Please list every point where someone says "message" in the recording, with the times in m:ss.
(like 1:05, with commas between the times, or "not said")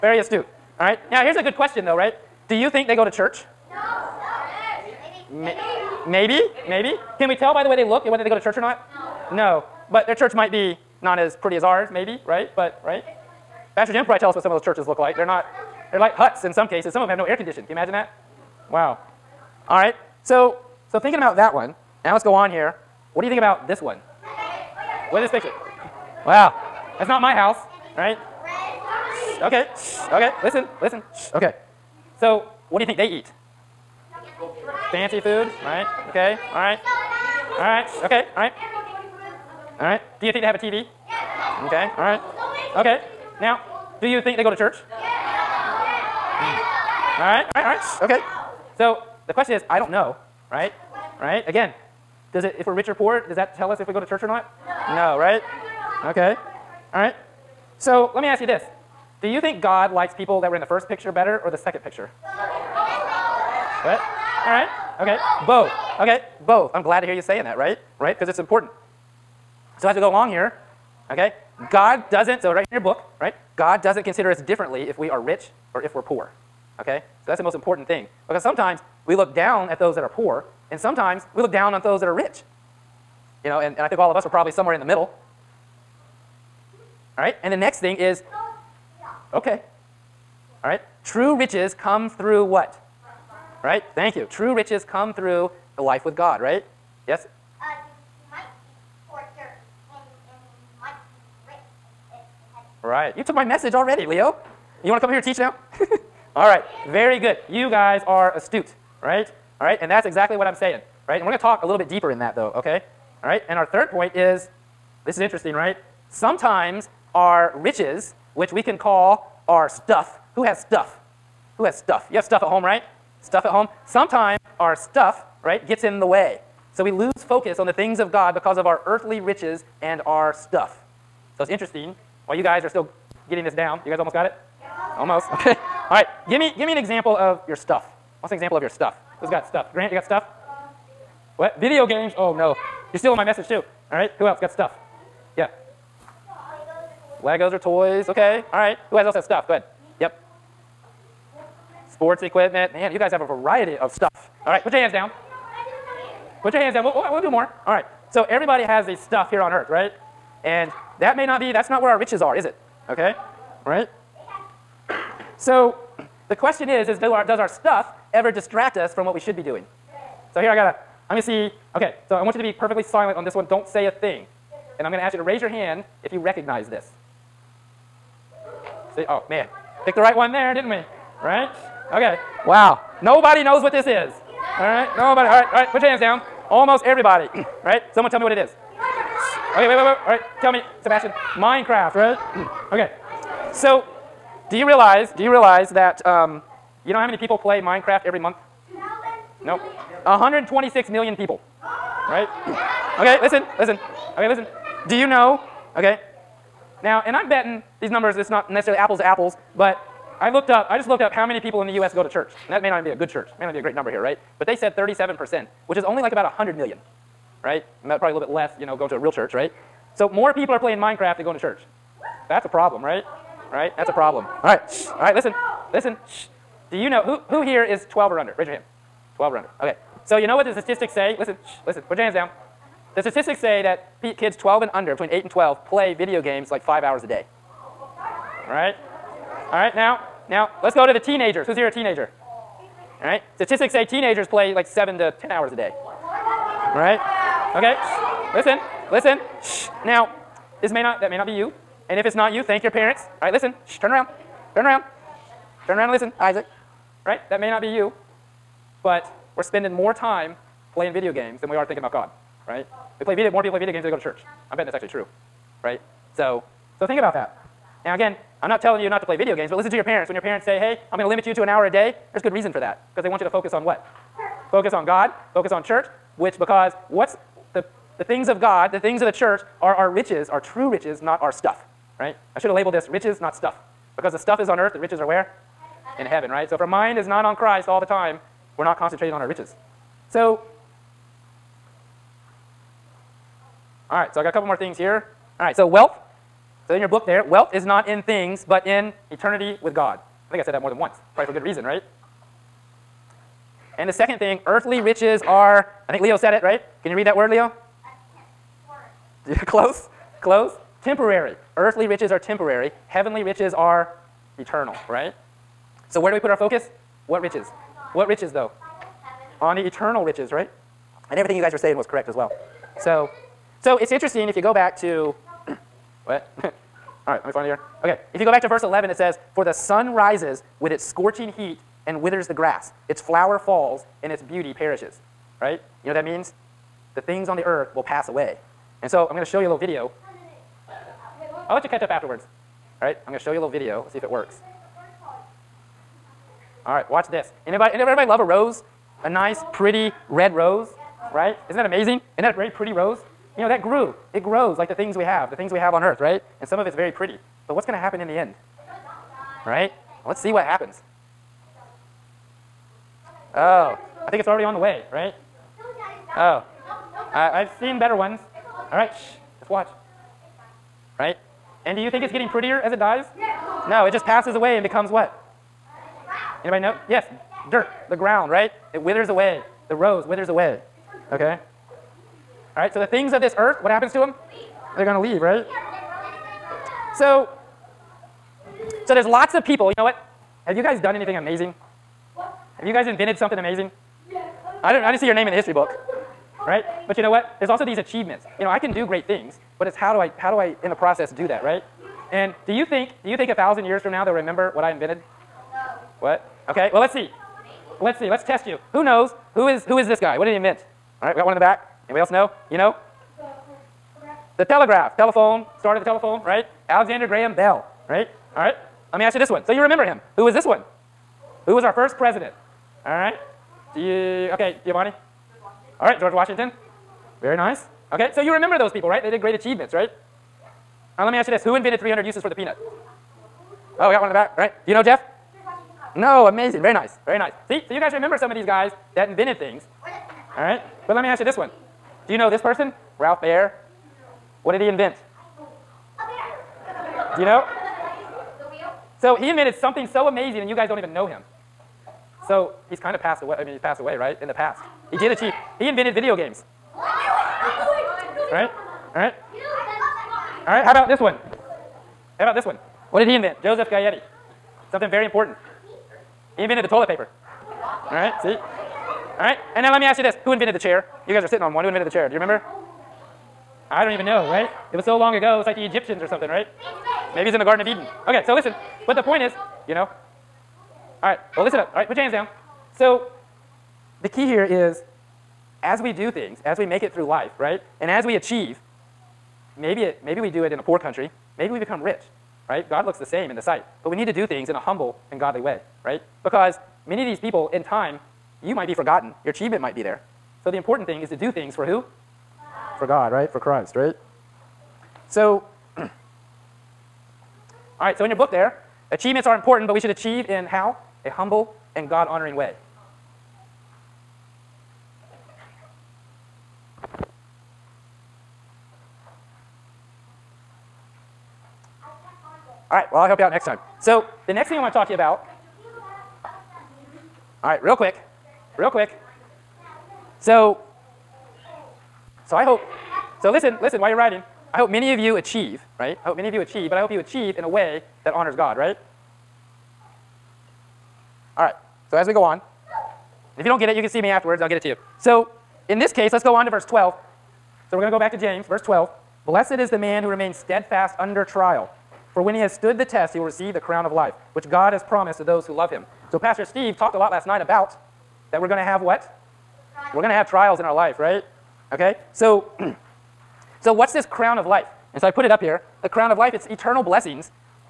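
1:43, 2:23.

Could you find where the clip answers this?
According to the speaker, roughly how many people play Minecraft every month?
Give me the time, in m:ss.
3:20.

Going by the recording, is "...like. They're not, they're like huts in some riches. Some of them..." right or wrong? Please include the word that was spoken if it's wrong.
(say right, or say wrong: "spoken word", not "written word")
wrong: "cases", not "riches".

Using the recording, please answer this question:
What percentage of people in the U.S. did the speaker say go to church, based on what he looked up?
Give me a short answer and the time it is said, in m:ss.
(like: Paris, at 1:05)
37%, at 3:34.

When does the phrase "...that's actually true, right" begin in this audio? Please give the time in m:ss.
4:24.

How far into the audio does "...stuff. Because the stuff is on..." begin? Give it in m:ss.
4:43.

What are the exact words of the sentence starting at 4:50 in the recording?
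So All right, so I got a couple more things here.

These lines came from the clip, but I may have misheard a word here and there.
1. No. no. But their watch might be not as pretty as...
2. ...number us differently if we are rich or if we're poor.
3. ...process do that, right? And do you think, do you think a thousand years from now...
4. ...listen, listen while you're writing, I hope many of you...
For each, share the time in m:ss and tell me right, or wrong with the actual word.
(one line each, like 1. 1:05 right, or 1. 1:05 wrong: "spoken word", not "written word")
1. 0:09 wrong: "church", not "watch"
2. 1:14 wrong: "consider", not "number"
3. 6:40 right
4. 8:53 right.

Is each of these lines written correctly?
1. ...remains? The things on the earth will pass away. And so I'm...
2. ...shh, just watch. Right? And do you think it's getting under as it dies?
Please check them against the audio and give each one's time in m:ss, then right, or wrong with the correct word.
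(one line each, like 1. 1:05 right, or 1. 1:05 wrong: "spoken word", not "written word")
1. 5:36 wrong: "means", not "remains"
2. 6:08 wrong: "prettier", not "under".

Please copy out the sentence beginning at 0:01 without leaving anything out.
Now, here's a good question, though, right?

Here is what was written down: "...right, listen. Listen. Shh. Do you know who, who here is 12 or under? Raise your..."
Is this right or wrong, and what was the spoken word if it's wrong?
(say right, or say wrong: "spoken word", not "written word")
right.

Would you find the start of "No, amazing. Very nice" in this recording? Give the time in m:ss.
7:15.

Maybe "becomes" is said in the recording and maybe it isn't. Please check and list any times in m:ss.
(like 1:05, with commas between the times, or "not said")
6:14, 8:11.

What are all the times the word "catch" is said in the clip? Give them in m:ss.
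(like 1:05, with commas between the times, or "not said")
5:41.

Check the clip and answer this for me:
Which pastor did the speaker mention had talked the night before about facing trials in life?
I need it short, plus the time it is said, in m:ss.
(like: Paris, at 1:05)
Pastor Steve, at 9:16.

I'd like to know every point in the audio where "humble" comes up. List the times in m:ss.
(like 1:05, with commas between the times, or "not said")
8:14, 8:31.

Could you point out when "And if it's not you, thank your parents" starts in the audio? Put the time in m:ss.
4:11.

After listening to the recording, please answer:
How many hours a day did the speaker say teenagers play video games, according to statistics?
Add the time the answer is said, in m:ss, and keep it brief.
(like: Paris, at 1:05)
7 to 10 hours, at 4:04.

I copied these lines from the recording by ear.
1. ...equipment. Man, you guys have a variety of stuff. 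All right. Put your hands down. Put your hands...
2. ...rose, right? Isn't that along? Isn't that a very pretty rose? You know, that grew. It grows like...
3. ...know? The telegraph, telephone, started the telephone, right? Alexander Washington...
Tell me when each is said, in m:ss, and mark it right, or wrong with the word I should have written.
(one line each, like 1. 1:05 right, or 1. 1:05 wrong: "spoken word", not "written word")
1. 2:32 right
2. 5:50 wrong: "amazing", not "along"
3. 6:52 wrong: "Graham", not "Washington".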